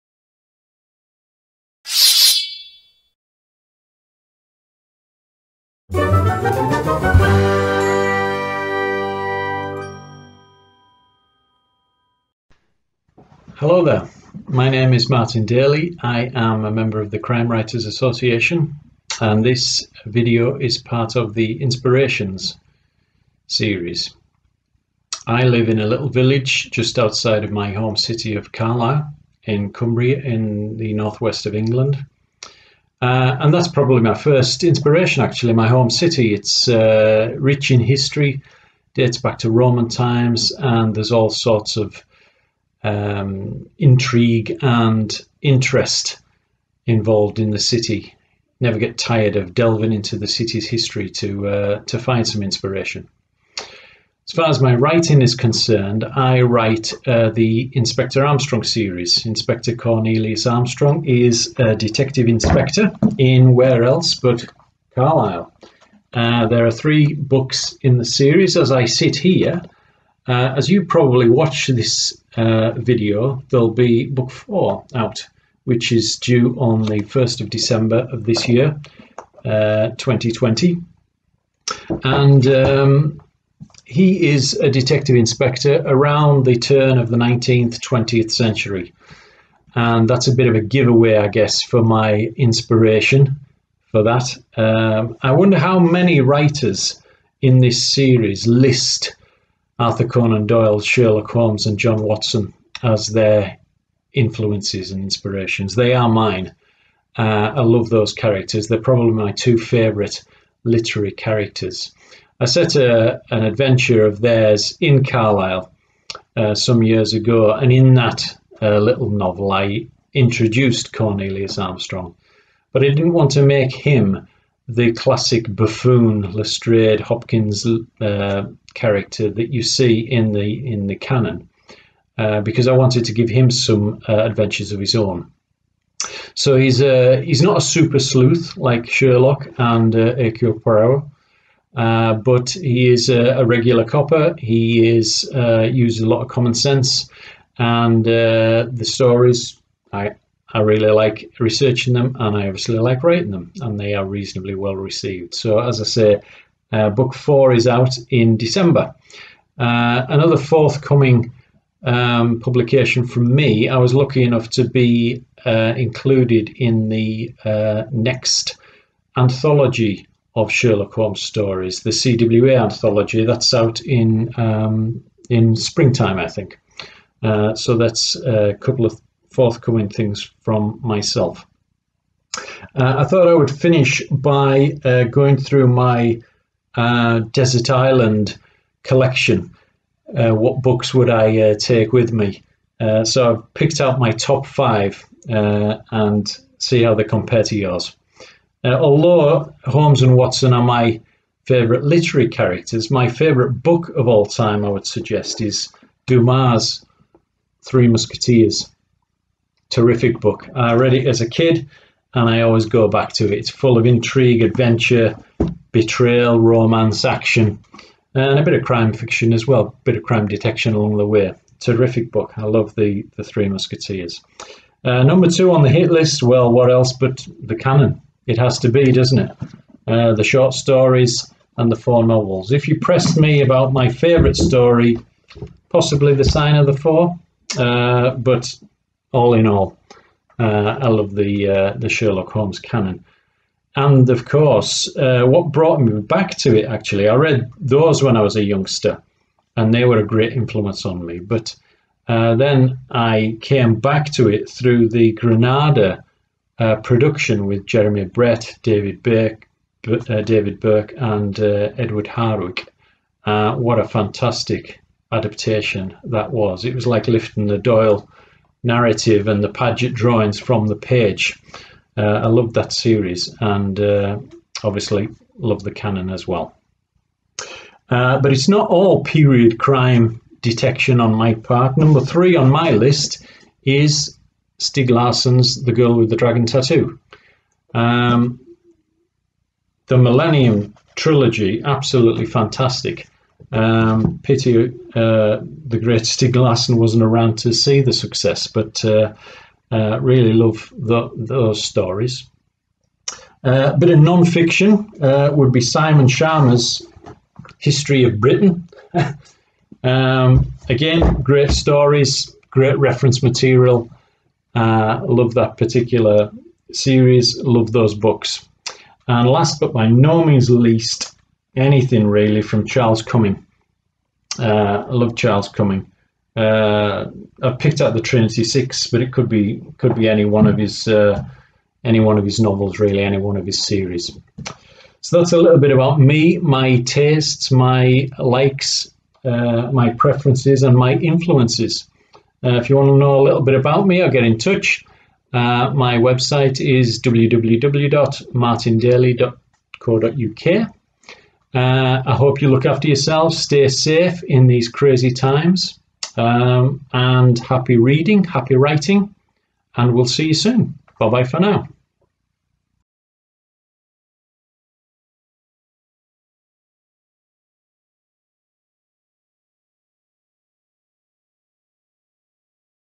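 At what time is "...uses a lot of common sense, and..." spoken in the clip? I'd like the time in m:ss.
2:25.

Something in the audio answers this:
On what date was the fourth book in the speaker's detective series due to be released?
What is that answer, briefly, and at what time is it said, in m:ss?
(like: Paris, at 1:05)
1st of December, at 1:17.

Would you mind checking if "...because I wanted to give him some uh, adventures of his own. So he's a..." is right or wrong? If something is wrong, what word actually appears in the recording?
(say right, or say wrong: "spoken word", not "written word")
right.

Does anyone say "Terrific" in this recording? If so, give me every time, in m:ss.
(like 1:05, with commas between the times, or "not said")
3:29, 3:41.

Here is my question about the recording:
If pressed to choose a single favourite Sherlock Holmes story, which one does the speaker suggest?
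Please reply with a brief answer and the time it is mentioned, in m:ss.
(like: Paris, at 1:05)
The Sign of the Four, at 3:56.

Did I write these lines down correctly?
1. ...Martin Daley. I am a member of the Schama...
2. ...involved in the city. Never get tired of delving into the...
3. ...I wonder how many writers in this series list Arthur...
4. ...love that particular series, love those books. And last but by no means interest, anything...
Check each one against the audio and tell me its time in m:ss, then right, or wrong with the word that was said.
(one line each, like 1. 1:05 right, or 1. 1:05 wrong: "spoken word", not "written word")
1. 0:15 wrong: "Crime", not "Schama"
2. 0:46 right
3. 1:35 right
4. 5:15 wrong: "least", not "interest".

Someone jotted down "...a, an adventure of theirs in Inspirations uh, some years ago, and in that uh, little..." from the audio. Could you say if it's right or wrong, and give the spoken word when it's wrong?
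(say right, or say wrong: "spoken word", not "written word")
wrong: "Carlisle", not "Inspirations".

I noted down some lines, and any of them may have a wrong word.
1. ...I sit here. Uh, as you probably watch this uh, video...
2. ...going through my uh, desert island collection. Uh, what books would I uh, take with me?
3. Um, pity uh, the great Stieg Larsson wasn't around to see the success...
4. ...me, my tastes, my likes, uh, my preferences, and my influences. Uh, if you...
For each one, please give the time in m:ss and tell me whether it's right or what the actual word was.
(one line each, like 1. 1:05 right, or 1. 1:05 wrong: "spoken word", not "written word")
1. 1:08 right
2. 3:05 right
3. 4:53 right
4. 5:35 right.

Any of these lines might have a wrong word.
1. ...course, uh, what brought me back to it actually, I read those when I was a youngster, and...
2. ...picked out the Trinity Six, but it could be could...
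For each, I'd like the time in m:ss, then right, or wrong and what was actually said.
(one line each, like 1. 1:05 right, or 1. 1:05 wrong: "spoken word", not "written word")
1. 4:04 right
2. 5:27 right.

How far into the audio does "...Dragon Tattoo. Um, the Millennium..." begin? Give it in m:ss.
4:46.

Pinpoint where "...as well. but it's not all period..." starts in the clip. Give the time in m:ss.
4:36.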